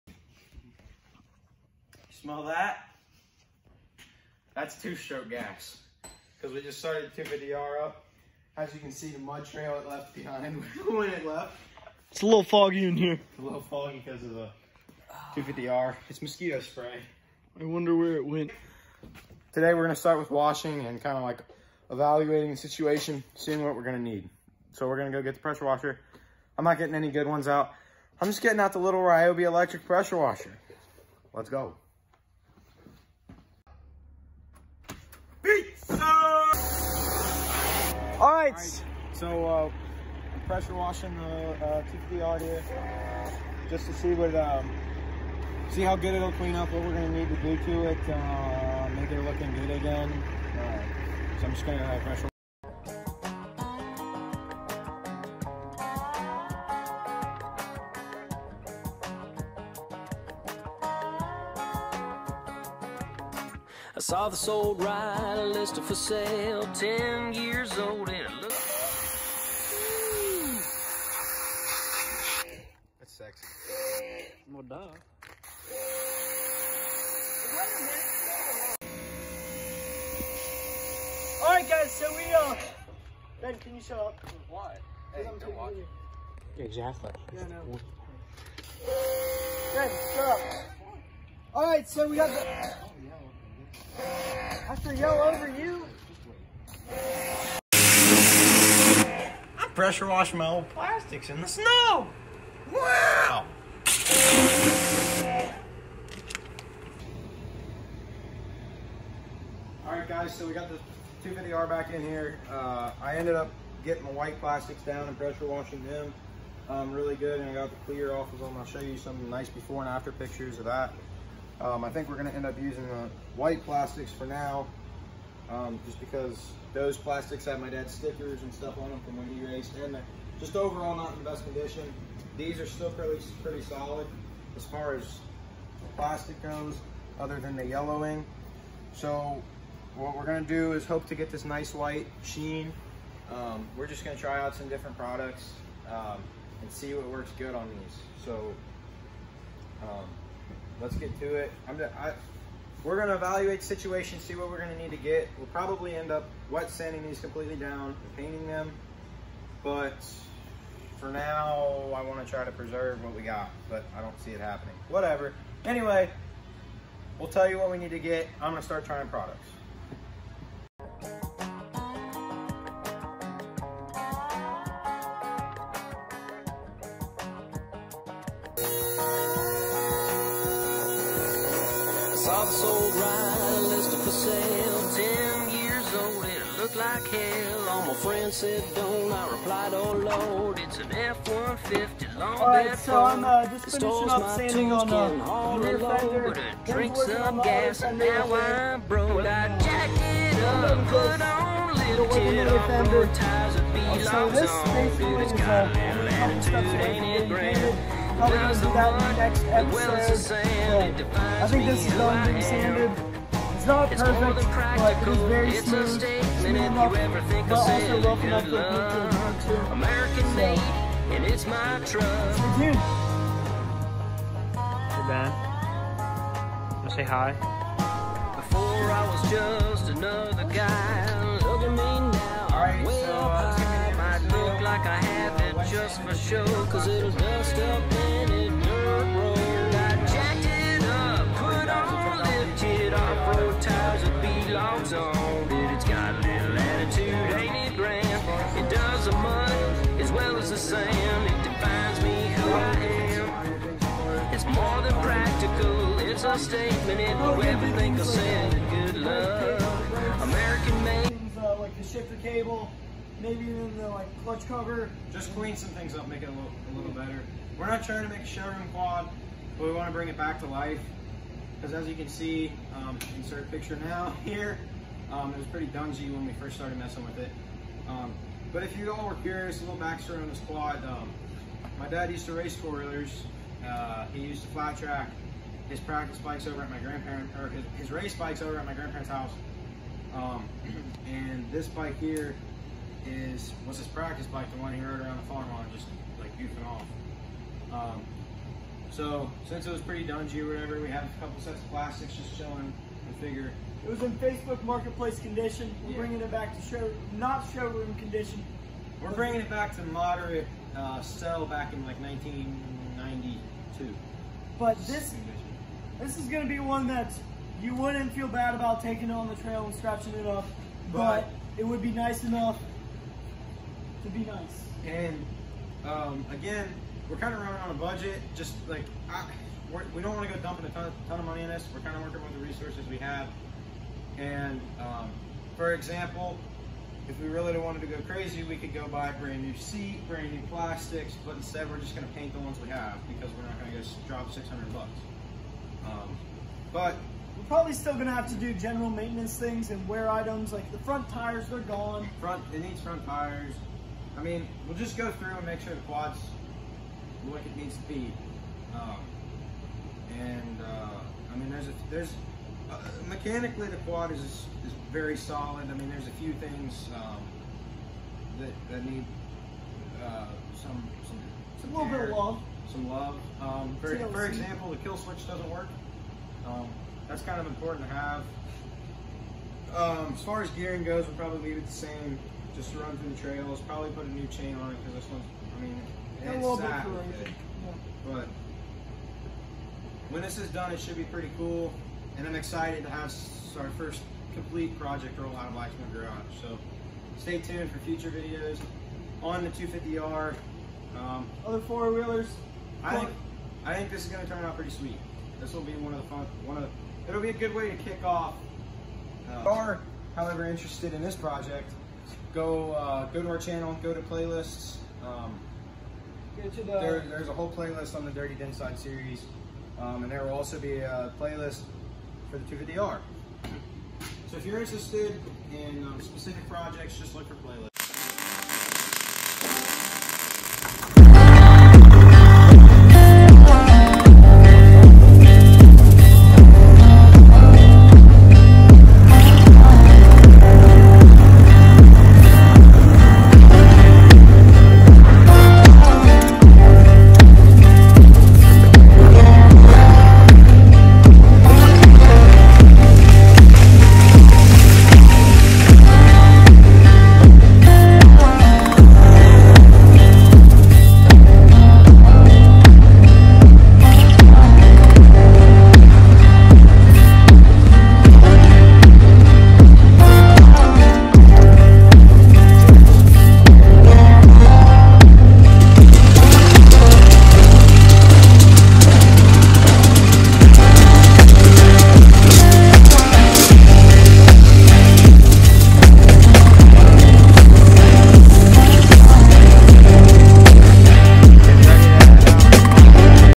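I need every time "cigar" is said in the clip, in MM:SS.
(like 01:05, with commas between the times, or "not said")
not said.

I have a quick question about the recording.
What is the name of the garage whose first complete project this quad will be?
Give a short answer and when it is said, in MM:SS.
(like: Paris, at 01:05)
Black Smoke Garage, at 06:35.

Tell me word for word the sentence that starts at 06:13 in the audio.
Um, for, for, example, the kill switch doesn't work.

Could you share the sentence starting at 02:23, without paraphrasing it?
Um, we're just gonna try out some different products um, and see what works good on these.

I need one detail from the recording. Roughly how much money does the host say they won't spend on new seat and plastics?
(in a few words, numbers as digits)
600 bucks.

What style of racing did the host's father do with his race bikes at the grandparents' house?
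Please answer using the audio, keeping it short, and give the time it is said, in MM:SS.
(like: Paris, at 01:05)
flat track, at 04:44.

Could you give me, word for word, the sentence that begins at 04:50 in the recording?
Um, and this bike here is was his practice bike, the one he rode around the farm on, just like goofing off.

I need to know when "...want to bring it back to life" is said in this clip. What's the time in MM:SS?
04:29.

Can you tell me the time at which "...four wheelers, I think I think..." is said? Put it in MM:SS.
06:41.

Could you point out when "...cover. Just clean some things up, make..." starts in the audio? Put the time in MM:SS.
04:24.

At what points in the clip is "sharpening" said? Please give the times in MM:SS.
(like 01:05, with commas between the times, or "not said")
not said.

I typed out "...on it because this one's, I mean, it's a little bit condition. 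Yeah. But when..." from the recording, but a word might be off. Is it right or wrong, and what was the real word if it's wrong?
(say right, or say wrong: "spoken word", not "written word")
wrong: "corrosion", not "condition".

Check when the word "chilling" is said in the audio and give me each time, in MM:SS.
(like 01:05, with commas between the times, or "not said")
05:02.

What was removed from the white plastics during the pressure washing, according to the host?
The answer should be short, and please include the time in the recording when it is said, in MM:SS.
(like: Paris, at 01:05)
the clear, at 01:57.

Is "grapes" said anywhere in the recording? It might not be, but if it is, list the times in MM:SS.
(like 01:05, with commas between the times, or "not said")
not said.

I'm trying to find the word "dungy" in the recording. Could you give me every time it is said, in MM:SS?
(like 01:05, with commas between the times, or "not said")
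04:35, 05:00.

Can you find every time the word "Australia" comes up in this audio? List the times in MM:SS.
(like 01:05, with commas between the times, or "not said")
not said.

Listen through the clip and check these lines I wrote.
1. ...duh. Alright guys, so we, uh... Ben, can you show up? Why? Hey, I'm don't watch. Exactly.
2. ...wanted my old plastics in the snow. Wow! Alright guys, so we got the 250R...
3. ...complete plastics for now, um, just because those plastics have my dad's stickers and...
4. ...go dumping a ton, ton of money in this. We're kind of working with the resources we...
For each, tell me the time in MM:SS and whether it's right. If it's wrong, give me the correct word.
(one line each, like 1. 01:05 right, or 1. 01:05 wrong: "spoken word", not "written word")
1. 01:14 right
2. 01:40 wrong: "washed", not "wanted"
3. 02:03 wrong: "white", not "complete"
4. 05:30 right.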